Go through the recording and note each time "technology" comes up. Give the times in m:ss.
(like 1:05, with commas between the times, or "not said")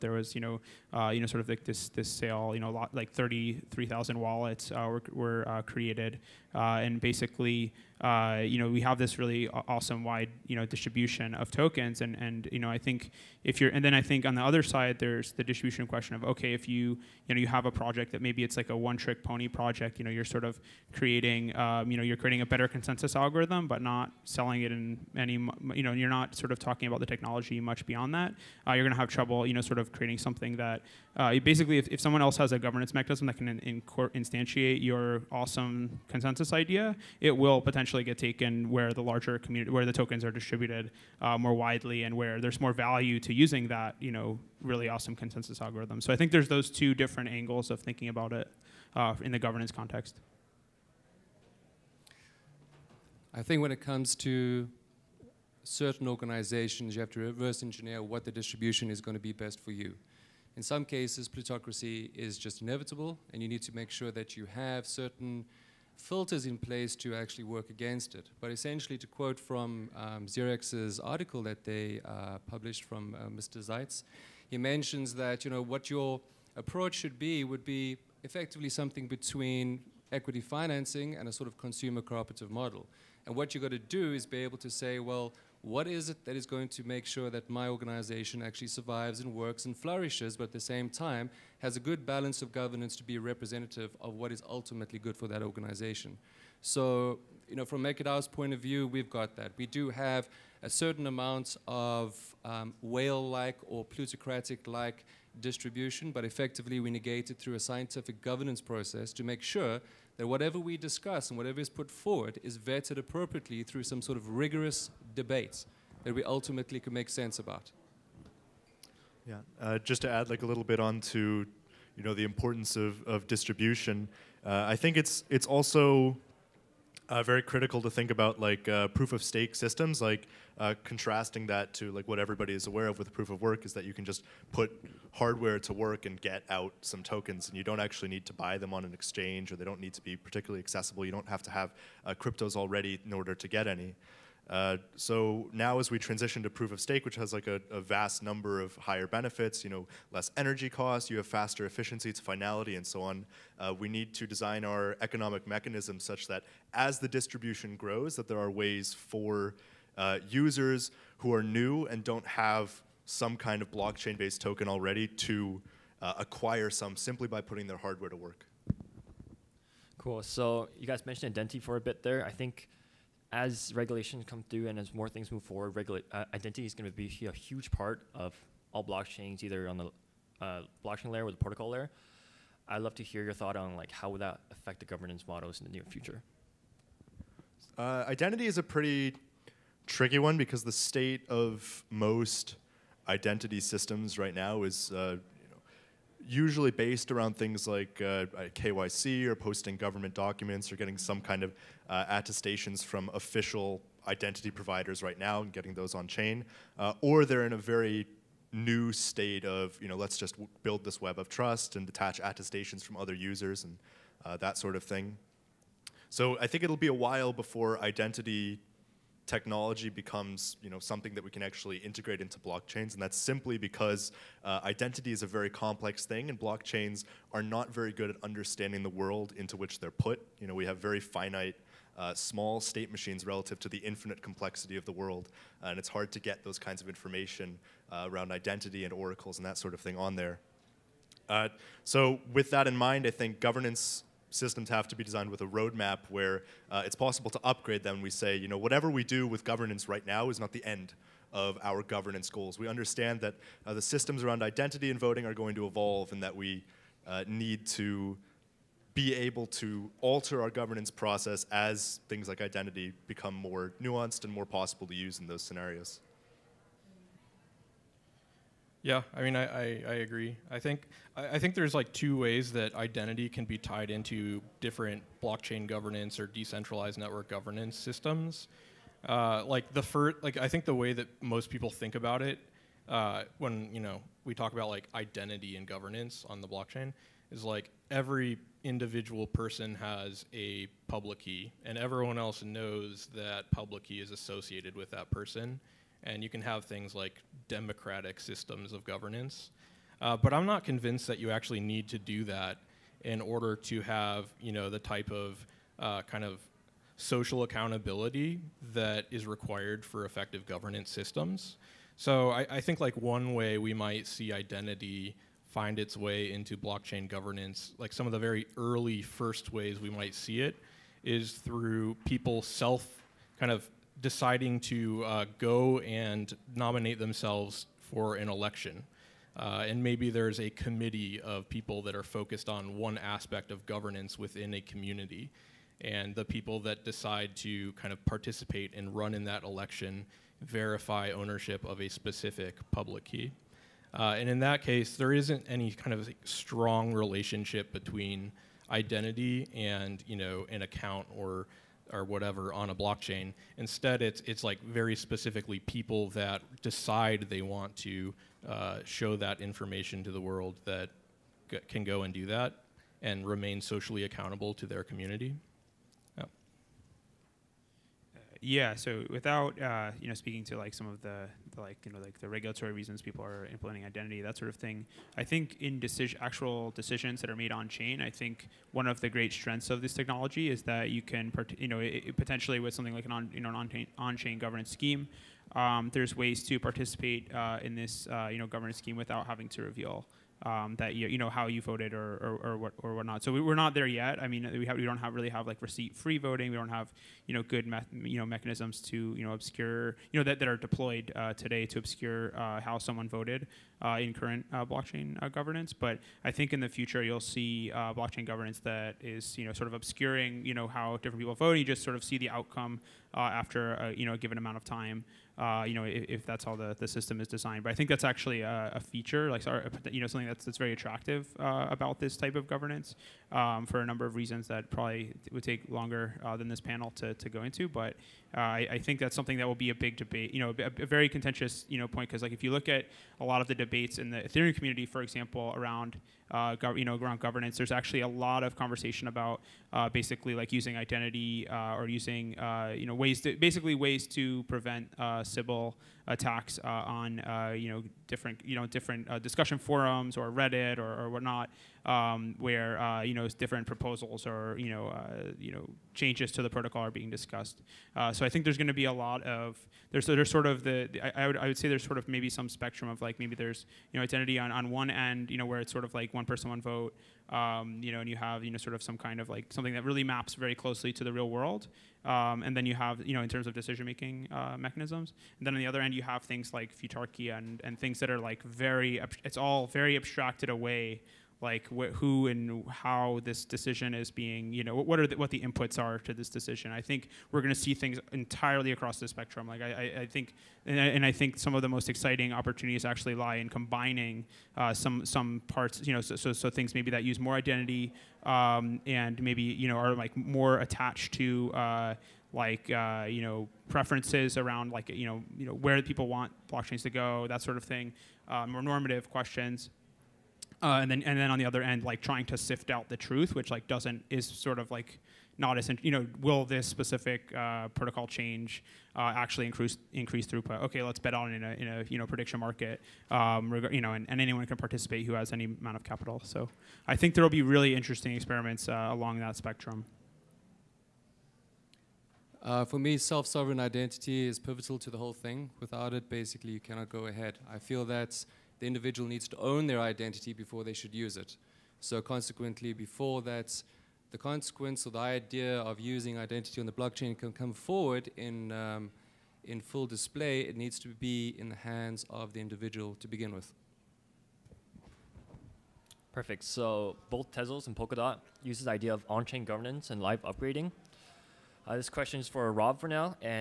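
0:27, 3:39, 6:19.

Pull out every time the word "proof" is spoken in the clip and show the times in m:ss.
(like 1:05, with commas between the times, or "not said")
2:08, 2:13, 2:26.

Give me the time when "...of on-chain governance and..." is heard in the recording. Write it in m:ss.
9:18.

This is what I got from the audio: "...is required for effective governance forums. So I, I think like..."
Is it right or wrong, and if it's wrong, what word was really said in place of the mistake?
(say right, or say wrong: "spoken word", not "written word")
wrong: "systems", not "forums".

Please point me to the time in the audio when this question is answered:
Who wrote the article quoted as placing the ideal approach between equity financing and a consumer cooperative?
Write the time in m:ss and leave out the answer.
1:13.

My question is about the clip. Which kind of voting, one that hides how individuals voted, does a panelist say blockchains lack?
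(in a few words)
Receipt free voting.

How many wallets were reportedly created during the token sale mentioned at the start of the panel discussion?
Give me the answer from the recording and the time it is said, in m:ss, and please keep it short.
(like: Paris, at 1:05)
33,000, at 0:03.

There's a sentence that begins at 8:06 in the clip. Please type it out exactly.
I think we're going to see things entirely across the spectrum.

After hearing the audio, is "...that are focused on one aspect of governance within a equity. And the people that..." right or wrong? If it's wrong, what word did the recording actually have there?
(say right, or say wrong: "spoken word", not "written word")
wrong: "community", not "equity".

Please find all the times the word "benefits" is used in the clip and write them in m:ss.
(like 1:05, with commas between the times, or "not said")
2:29.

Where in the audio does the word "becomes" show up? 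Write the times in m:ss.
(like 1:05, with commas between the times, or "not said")
3:39, 4:23.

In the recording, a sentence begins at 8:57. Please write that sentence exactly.
I feel that the individual needs to own their identity before they should use it.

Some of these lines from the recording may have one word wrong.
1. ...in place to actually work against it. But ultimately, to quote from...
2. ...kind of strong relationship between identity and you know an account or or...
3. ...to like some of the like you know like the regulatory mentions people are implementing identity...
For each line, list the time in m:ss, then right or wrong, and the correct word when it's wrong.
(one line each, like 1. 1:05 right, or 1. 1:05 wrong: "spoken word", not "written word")
1. 1:06 wrong: "essentially", not "ultimately"
2. 5:45 right
3. 6:10 wrong: "reasons", not "mentions".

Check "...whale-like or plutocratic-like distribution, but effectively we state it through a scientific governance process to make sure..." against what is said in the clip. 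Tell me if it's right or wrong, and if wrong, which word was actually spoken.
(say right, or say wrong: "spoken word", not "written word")
wrong: "negate", not "state".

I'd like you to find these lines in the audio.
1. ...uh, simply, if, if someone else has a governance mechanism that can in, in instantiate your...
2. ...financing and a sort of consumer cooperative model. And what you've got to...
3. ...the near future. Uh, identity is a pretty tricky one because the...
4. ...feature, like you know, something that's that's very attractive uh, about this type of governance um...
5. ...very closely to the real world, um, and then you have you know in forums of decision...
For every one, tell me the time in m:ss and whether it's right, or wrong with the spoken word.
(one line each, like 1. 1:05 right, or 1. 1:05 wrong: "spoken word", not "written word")
1. 0:31 wrong: "basically", not "simply"
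2. 1:20 right
3. 3:05 right
4. 6:58 right
5. 7:50 wrong: "terms", not "forums".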